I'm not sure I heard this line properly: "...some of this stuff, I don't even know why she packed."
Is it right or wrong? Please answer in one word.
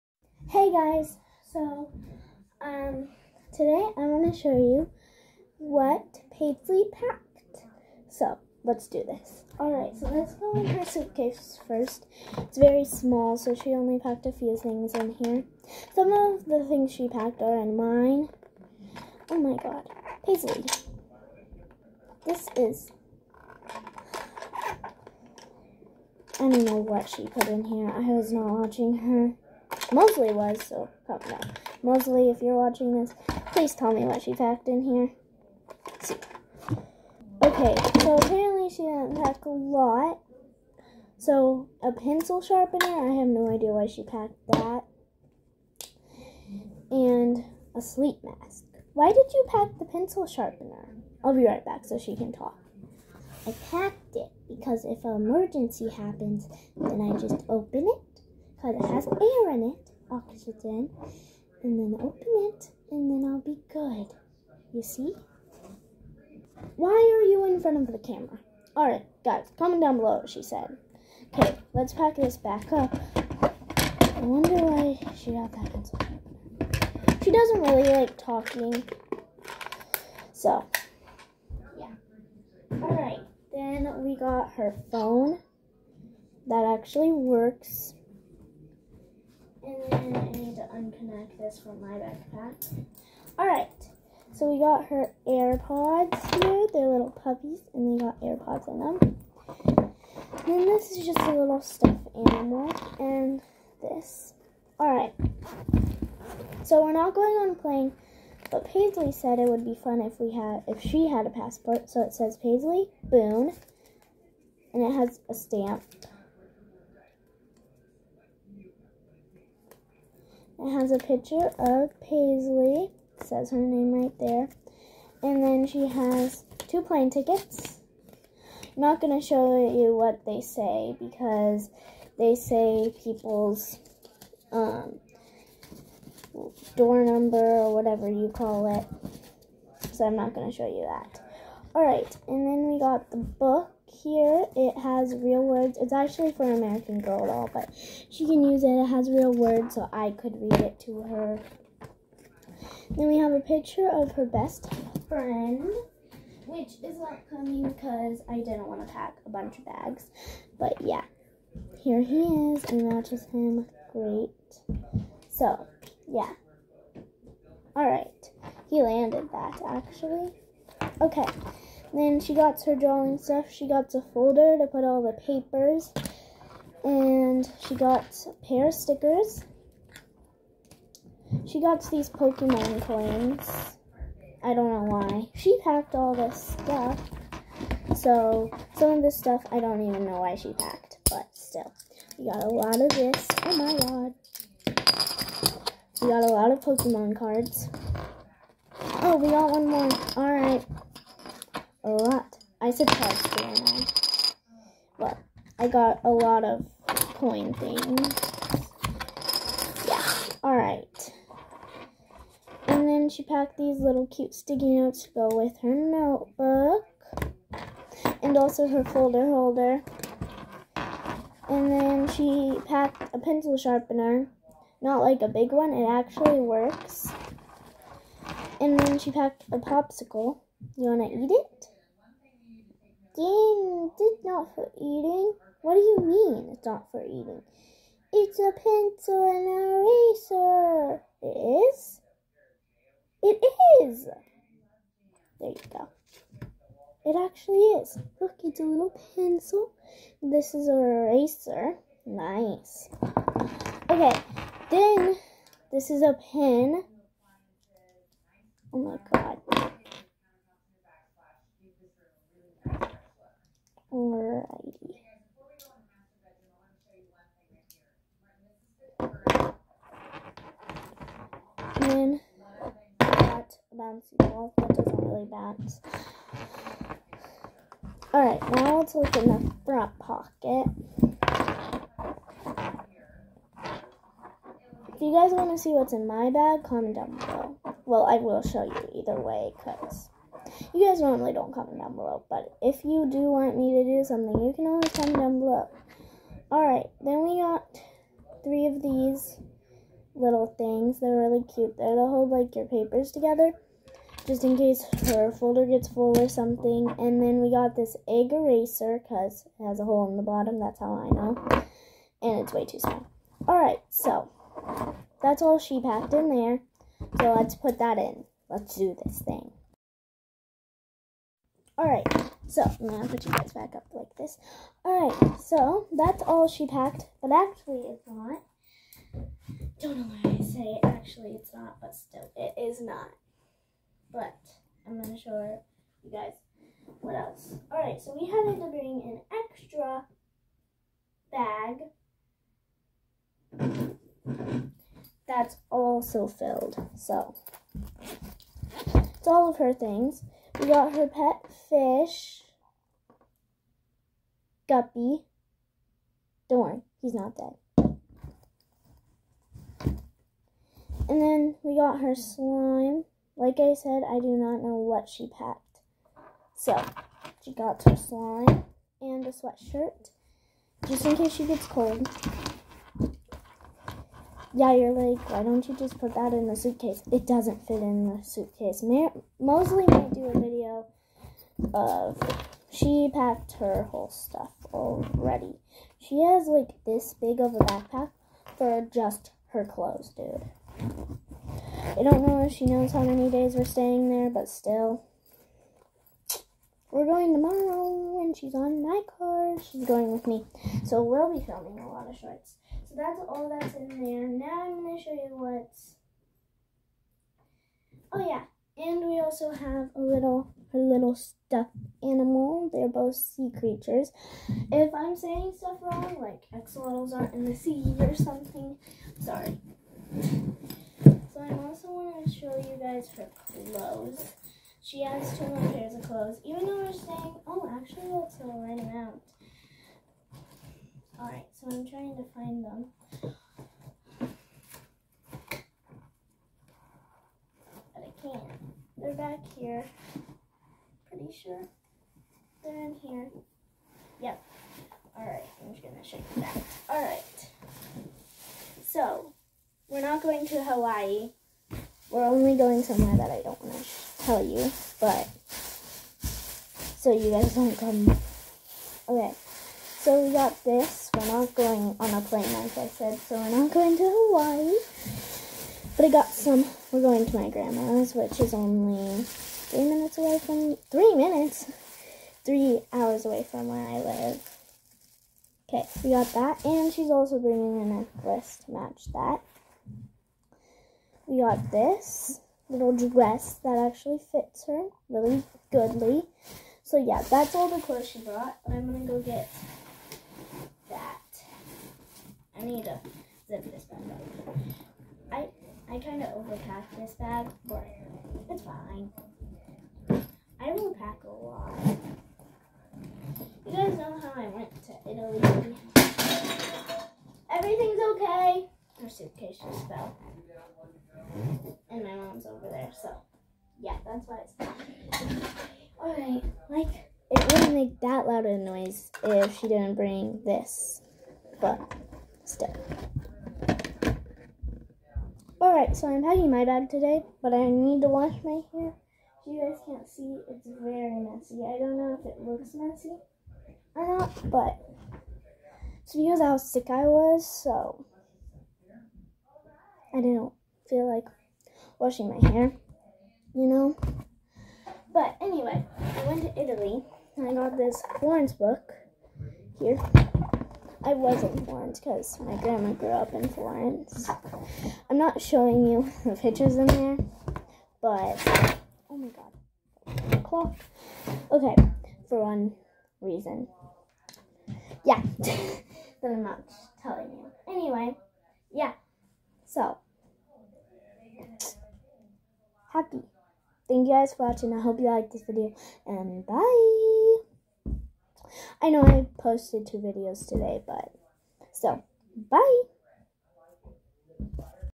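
right.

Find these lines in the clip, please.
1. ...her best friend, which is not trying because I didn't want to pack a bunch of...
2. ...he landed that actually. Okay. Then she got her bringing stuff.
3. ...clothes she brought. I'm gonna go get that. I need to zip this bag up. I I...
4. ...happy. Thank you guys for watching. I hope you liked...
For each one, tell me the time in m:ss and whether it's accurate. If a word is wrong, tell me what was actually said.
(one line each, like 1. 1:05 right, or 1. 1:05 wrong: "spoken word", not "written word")
1. 2:34 wrong: "coming", not "trying"
2. 2:48 wrong: "drawing", not "bringing"
3. 8:07 right
4. 9:32 right.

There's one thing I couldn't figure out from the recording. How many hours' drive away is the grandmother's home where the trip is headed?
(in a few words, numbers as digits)
3 hours.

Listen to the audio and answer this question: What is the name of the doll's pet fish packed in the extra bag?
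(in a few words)
Guppy.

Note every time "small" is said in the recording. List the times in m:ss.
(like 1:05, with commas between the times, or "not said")
0:12, 5:12.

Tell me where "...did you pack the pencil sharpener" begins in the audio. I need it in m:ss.
0:49.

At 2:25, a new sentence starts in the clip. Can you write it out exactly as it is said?
It's actually for American Girl doll, but she can use it.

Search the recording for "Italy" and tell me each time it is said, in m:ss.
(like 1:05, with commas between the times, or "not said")
8:25, 9:06.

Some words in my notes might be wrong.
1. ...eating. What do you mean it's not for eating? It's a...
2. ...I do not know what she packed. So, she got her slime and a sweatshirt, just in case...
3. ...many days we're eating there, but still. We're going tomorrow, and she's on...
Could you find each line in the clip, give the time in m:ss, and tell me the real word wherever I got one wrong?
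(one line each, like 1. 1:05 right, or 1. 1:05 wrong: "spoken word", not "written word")
1. 3:54 right
2. 6:04 right
3. 6:33 wrong: "staying", not "eating".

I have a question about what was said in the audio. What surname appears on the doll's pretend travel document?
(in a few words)
Boone.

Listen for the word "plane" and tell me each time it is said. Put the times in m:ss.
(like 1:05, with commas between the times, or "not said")
1:47, 2:06, 7:42.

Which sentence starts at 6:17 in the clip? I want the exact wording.
It doesn't fit in the suitcase.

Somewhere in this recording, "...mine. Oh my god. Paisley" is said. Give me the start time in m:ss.
0:17.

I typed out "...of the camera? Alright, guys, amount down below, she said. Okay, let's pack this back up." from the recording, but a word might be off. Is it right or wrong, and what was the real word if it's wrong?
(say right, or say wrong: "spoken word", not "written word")
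wrong: "comment", not "amount".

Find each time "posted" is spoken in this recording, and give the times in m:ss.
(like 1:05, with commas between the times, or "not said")
9:39.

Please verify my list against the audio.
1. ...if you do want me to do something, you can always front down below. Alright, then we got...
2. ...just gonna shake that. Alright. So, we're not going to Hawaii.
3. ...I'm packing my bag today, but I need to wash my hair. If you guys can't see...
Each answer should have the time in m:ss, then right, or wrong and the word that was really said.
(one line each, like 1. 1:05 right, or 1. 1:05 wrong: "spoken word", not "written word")
1. 4:52 wrong: "comment", not "front"
2. 7:25 right
3. 8:46 right.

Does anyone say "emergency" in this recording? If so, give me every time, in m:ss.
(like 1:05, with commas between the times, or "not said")
0:55.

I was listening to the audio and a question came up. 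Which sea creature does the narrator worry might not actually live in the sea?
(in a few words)
Axolotls.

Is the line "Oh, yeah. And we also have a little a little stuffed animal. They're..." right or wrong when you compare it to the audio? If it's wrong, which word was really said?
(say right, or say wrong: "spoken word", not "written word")
right.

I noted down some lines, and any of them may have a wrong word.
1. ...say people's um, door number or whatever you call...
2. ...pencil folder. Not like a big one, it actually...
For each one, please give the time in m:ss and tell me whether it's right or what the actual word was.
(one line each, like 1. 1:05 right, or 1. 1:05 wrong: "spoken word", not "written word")
1. 2:12 right
2. 3:43 wrong: "sharpener", not "folder".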